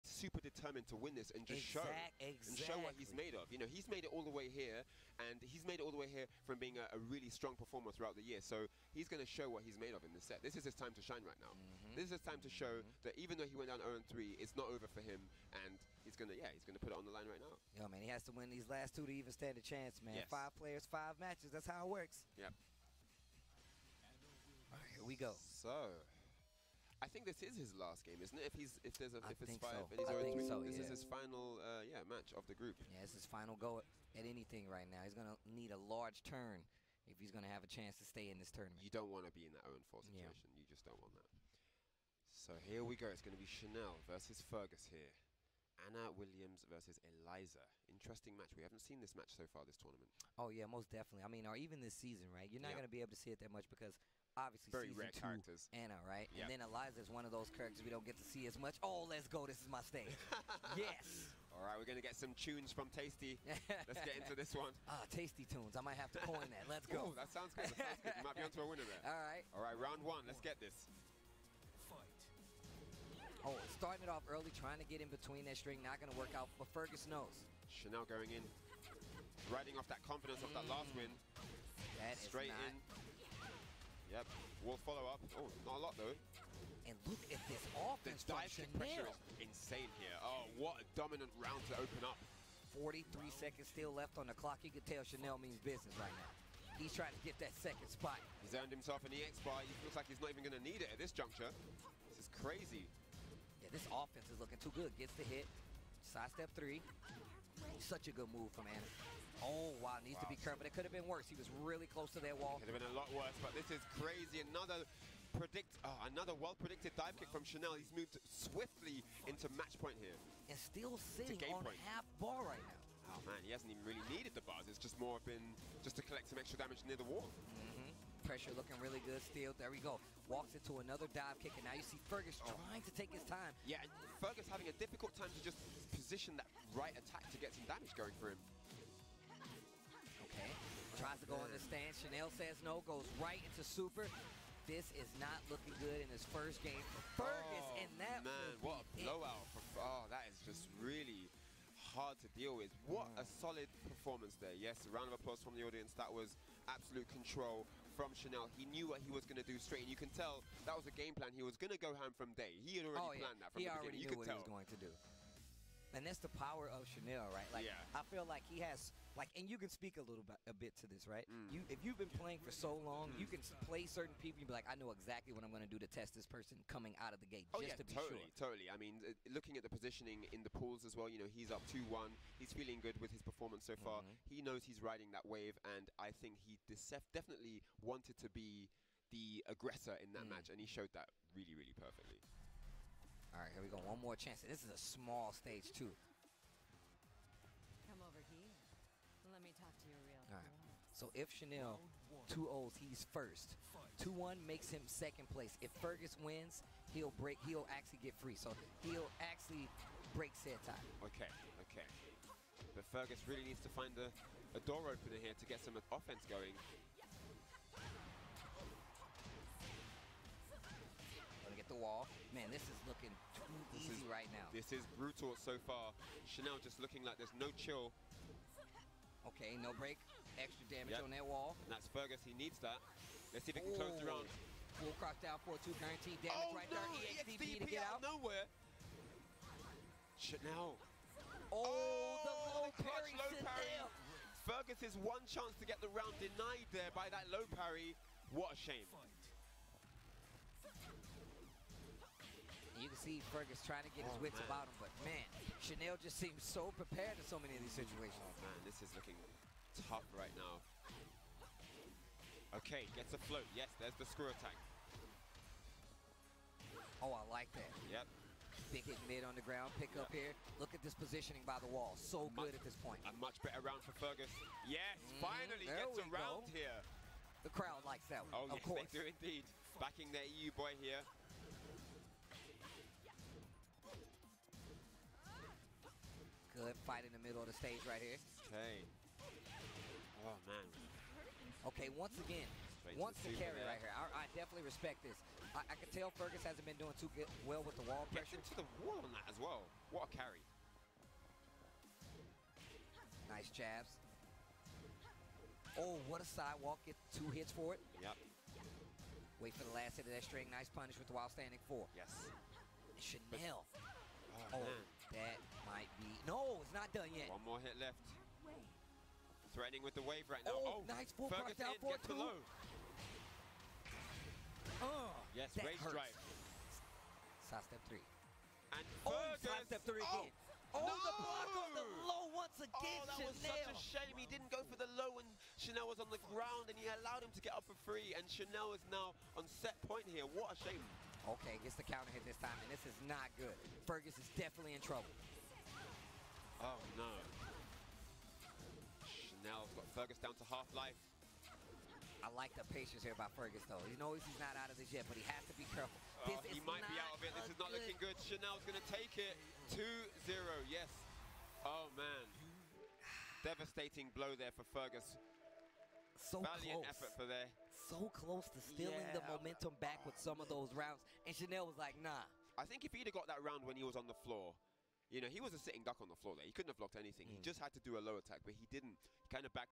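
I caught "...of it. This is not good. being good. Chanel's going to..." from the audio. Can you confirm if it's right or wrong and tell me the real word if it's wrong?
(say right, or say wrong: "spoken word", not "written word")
wrong: "looking", not "being".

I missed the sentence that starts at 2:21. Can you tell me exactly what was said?
Chanel says no, goes right into super.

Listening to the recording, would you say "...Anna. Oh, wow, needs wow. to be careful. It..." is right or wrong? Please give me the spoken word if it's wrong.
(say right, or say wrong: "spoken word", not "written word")
right.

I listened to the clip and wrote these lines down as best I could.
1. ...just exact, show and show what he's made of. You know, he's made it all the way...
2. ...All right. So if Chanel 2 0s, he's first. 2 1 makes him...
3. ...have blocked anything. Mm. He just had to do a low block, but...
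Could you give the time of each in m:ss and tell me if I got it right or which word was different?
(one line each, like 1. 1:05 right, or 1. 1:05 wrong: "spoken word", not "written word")
1. 0:01 right
2. 3:20 right
3. 6:16 wrong: "attack", not "block".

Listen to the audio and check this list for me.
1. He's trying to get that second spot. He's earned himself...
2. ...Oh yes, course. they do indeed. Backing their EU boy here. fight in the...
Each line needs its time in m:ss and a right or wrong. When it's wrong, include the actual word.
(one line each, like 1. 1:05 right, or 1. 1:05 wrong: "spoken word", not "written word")
1. 1:36 right
2. 4:38 right.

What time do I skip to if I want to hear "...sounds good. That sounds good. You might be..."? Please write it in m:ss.
1:07.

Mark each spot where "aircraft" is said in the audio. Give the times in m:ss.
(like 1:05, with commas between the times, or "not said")
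not said.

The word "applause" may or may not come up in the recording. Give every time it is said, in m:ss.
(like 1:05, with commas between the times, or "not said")
2:35.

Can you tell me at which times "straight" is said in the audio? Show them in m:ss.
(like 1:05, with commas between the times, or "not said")
1:22, 2:39, 4:52.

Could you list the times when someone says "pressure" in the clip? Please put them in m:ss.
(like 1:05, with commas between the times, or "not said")
1:28, 2:08, 4:58.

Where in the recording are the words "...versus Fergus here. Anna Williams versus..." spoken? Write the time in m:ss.
0:44.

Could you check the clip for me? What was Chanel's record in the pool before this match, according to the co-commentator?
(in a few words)
2-1.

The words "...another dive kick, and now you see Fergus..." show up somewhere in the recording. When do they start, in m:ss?
2:10.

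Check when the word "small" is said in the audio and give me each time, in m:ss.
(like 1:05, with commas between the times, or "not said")
3:14.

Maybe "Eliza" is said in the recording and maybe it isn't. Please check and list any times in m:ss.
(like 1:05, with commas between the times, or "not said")
0:47, 0:56.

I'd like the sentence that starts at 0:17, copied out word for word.
Yo, man, he has to win these last two to even stand a chance, man.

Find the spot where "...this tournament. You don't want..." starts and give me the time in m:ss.
0:38.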